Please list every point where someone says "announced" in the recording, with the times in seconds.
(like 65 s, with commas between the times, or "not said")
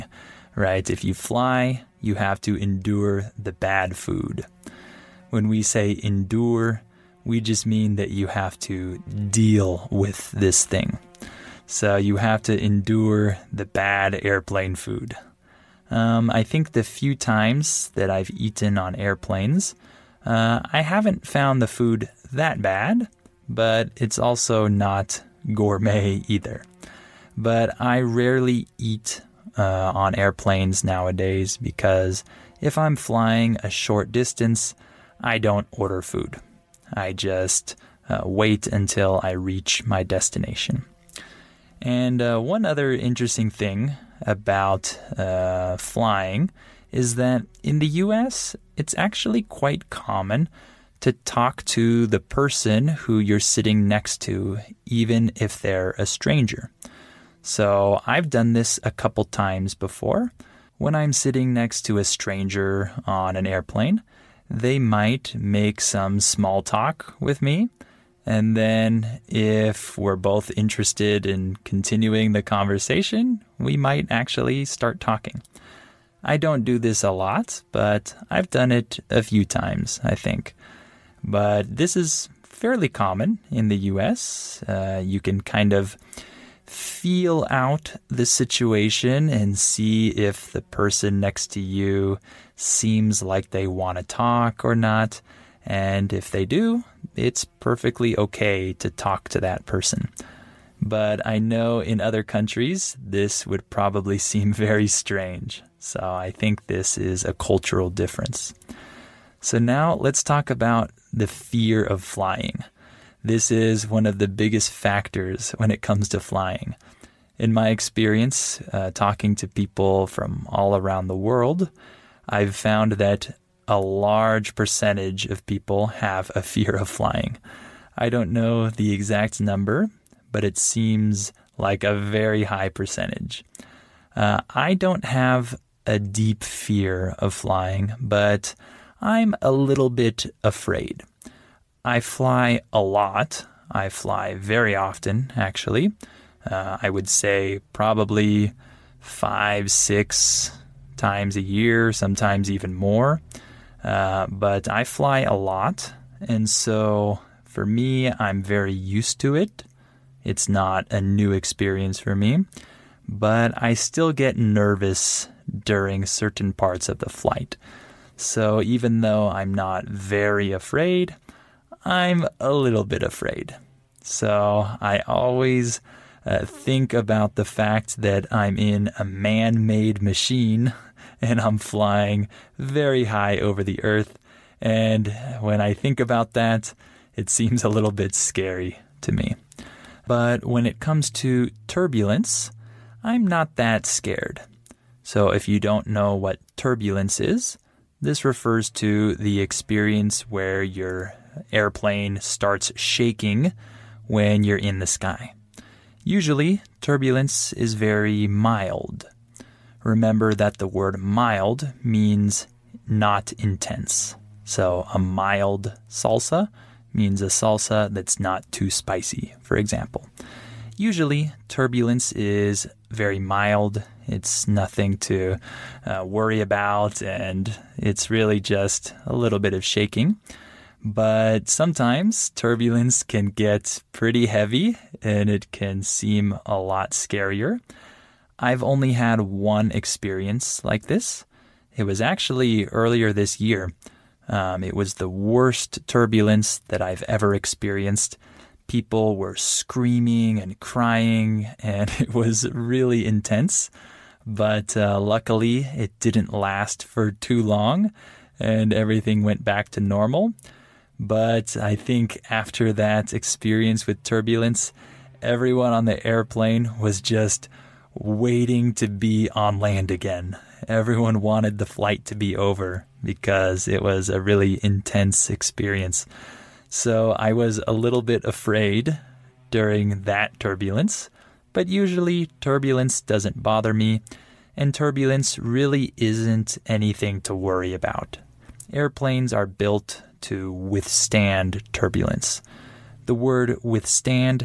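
not said.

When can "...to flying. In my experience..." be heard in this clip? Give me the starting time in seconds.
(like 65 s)
116 s.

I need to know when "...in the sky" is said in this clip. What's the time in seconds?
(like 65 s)
204 s.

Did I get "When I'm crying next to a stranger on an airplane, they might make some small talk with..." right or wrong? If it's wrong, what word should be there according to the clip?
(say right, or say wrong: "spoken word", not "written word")
wrong: "sitting", not "crying".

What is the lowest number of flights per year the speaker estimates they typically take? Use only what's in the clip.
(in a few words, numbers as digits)
5.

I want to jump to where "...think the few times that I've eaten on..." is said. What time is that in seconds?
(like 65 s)
16 s.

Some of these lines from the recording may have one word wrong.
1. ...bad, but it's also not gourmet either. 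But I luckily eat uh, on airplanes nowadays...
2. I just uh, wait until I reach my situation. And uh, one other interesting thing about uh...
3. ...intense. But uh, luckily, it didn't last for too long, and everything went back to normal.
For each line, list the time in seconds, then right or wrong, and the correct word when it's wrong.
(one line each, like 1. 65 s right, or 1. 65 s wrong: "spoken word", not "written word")
1. 22 s wrong: "rarely", not "luckily"
2. 36 s wrong: "destination", not "situation"
3. 253 s right.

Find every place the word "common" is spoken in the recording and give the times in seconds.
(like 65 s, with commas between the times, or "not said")
49 s, 82 s.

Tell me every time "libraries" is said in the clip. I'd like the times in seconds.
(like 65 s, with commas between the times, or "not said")
not said.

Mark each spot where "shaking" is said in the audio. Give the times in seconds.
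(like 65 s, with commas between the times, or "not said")
202 s, 229 s.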